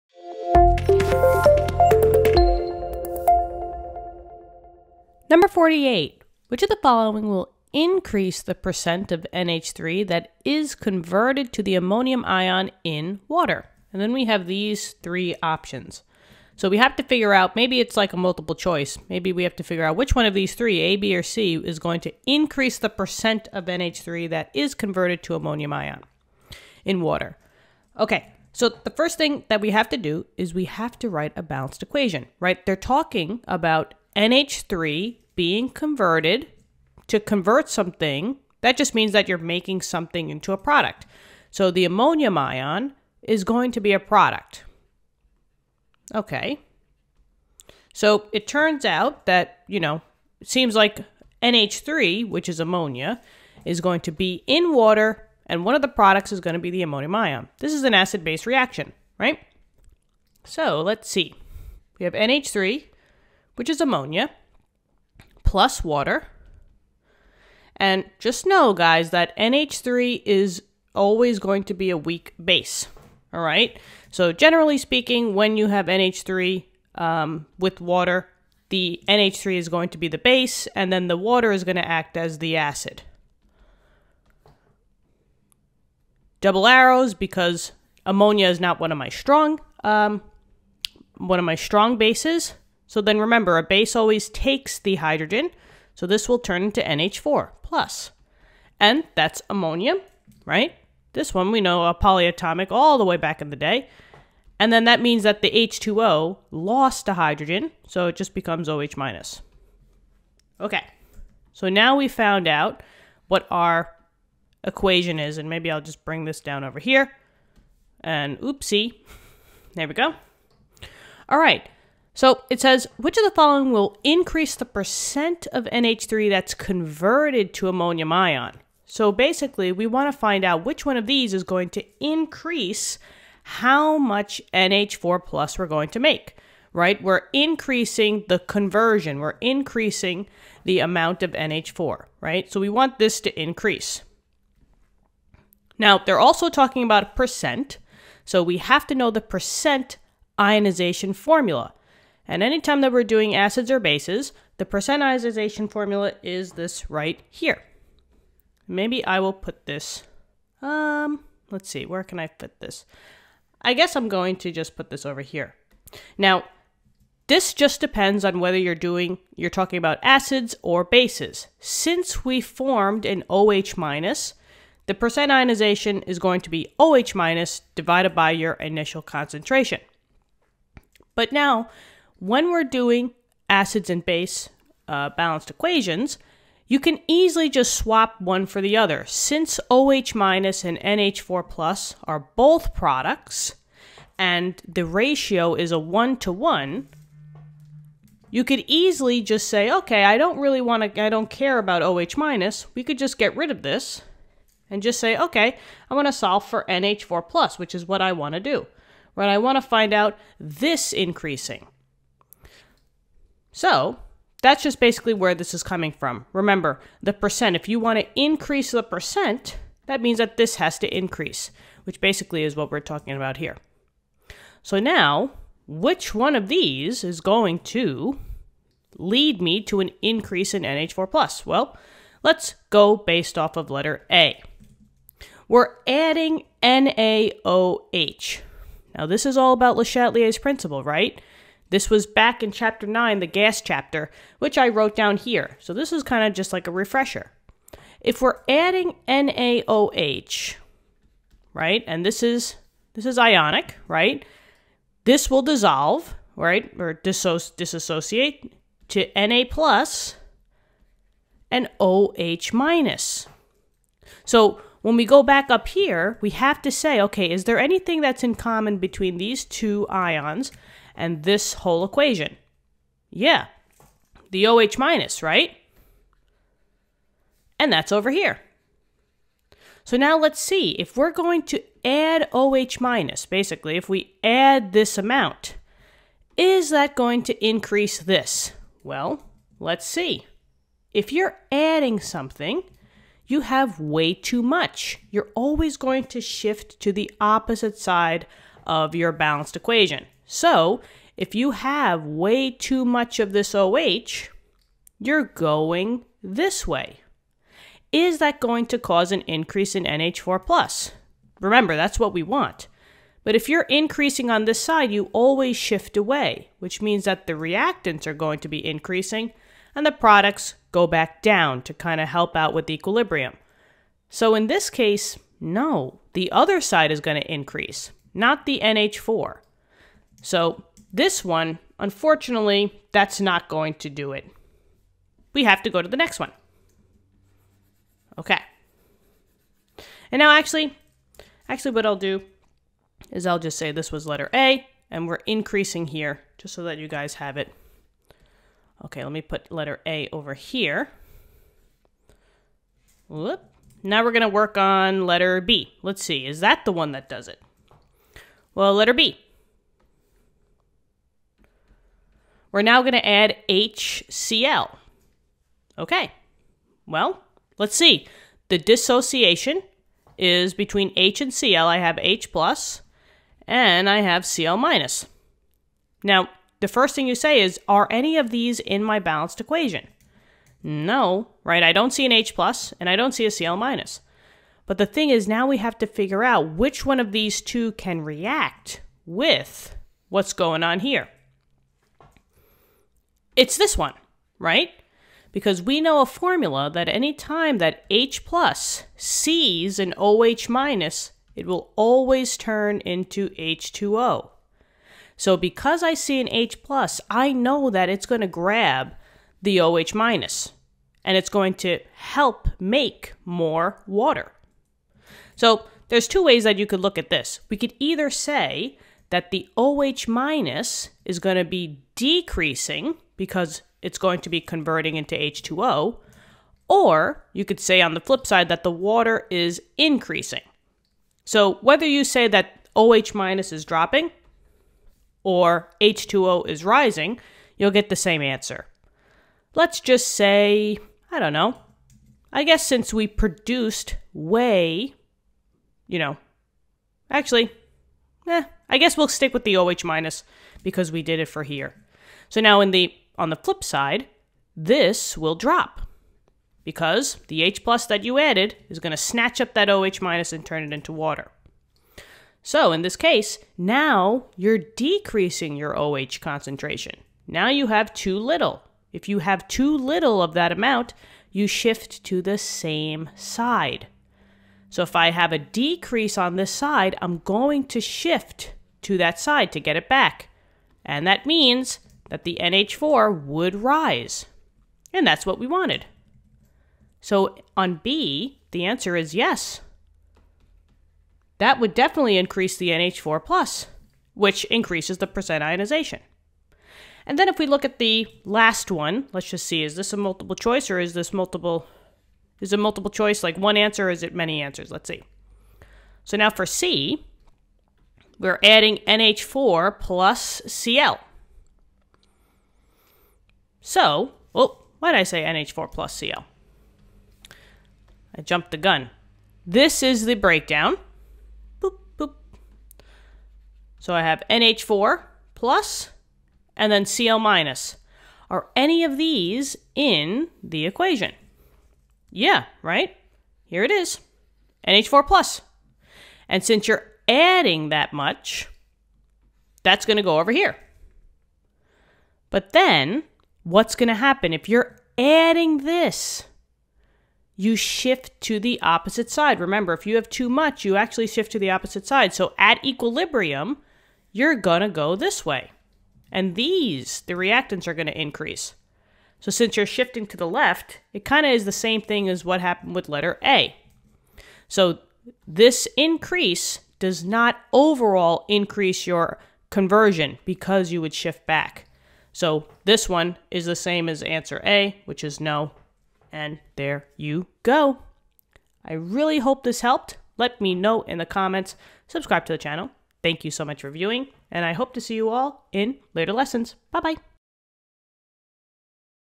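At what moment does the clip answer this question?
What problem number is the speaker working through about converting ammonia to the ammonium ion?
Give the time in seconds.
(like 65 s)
5 s.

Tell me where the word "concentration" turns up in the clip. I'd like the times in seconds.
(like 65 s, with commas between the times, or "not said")
179 s, 466 s.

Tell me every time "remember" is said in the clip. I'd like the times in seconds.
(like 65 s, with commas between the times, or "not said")
93 s, 216 s, 311 s, 549 s.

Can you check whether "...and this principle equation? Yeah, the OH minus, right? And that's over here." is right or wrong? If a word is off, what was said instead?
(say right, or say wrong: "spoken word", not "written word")
wrong: "whole", not "principle".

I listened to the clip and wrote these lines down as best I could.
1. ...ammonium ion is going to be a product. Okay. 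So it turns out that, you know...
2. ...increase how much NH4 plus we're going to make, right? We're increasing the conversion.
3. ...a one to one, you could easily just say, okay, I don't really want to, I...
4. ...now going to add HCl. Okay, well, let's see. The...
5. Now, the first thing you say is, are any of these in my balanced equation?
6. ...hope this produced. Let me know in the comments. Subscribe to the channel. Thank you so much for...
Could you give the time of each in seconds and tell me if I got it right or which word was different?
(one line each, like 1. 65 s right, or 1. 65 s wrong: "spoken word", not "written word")
1. 41 s right
2. 132 s right
3. 195 s right
4. 362 s right
5. 376 s right
6. 579 s wrong: "helped", not "produced".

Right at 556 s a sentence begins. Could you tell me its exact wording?
And these, the reactants, are going to increase.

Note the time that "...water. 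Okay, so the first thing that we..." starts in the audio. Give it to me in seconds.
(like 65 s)
27 s.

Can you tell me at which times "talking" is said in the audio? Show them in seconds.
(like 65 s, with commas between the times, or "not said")
32 s, 146 s, 169 s, 222 s.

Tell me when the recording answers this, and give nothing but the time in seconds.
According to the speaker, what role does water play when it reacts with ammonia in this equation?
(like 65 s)
82 s.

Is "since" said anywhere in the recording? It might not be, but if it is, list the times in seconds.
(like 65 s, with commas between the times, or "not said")
171 s, 189 s, 442 s, 536 s, 559 s.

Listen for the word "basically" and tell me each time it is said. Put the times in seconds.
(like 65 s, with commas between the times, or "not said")
129 s, 214 s, 221 s, 283 s.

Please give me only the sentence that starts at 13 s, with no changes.
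And then we have these three options.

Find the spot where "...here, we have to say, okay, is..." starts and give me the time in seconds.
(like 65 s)
265 s.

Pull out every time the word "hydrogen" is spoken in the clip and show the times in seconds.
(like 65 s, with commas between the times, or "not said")
94 s, 107 s.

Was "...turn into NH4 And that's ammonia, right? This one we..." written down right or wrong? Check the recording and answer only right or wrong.
right.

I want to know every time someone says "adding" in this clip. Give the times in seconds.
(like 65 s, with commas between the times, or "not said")
235 s, 248 s, 291 s, 508 s, 537 s, 544 s.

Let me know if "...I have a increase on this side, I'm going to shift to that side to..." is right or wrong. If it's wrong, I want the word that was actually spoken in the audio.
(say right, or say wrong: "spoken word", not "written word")
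wrong: "decrease", not "increase".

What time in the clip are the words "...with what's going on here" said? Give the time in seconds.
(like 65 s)
389 s.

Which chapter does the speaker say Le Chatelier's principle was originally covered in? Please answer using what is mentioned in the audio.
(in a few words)
chapter 9.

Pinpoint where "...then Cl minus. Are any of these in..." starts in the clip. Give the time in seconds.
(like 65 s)
526 s.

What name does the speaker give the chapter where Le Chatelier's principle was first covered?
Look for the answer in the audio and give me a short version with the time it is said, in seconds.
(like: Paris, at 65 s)
the gas chapter, at 243 s.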